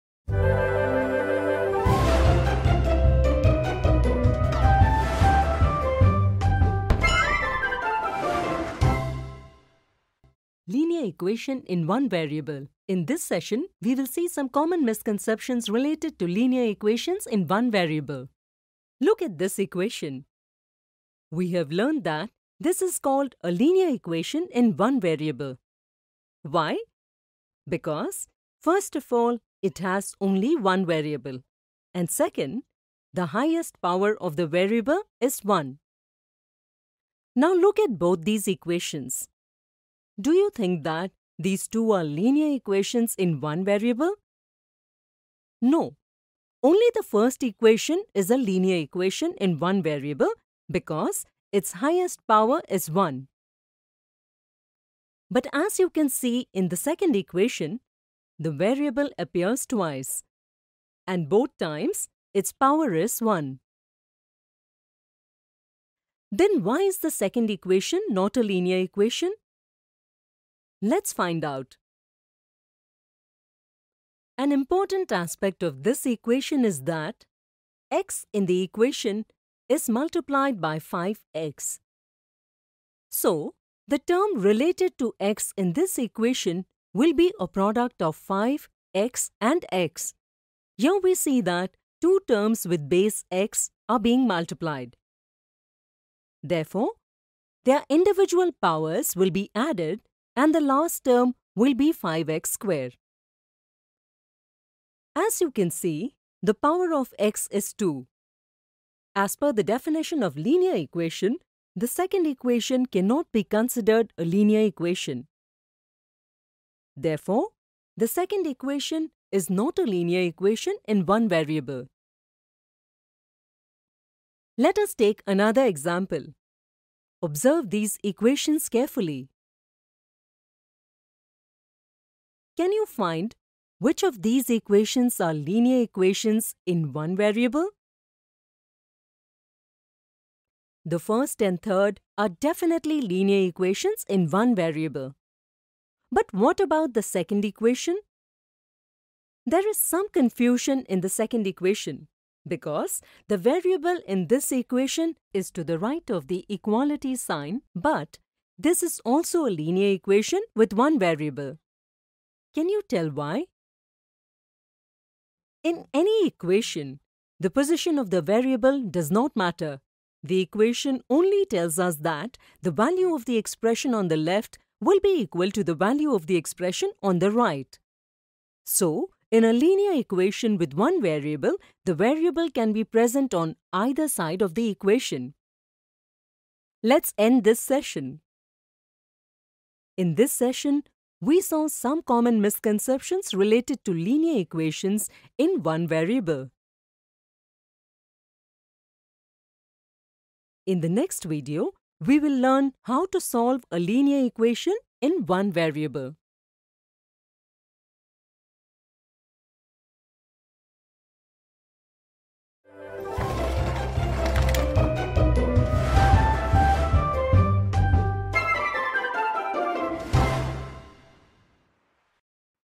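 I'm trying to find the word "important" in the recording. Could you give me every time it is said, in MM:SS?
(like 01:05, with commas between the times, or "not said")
01:14.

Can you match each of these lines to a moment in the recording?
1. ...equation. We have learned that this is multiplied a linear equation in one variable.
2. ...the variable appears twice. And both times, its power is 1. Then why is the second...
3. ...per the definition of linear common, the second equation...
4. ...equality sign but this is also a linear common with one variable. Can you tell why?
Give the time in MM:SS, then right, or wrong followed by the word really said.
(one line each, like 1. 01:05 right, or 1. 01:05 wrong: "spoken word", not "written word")
1. 00:19 wrong: "called", not "multiplied"
2. 00:58 right
3. 01:49 wrong: "equation", not "common"
4. 02:36 wrong: "equation", not "common".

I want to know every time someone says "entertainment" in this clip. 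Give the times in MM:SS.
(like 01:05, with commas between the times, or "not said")
not said.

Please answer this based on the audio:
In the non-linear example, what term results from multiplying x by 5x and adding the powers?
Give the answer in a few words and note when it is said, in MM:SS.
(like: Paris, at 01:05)
5x squared, at 01:41.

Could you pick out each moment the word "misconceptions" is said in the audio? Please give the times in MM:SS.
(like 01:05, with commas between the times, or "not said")
00:14, 03:12.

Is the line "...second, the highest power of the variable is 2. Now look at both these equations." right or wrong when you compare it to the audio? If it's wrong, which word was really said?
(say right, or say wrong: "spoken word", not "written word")
wrong: "1", not "2".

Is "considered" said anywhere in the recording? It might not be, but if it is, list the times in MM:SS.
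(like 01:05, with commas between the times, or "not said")
01:53.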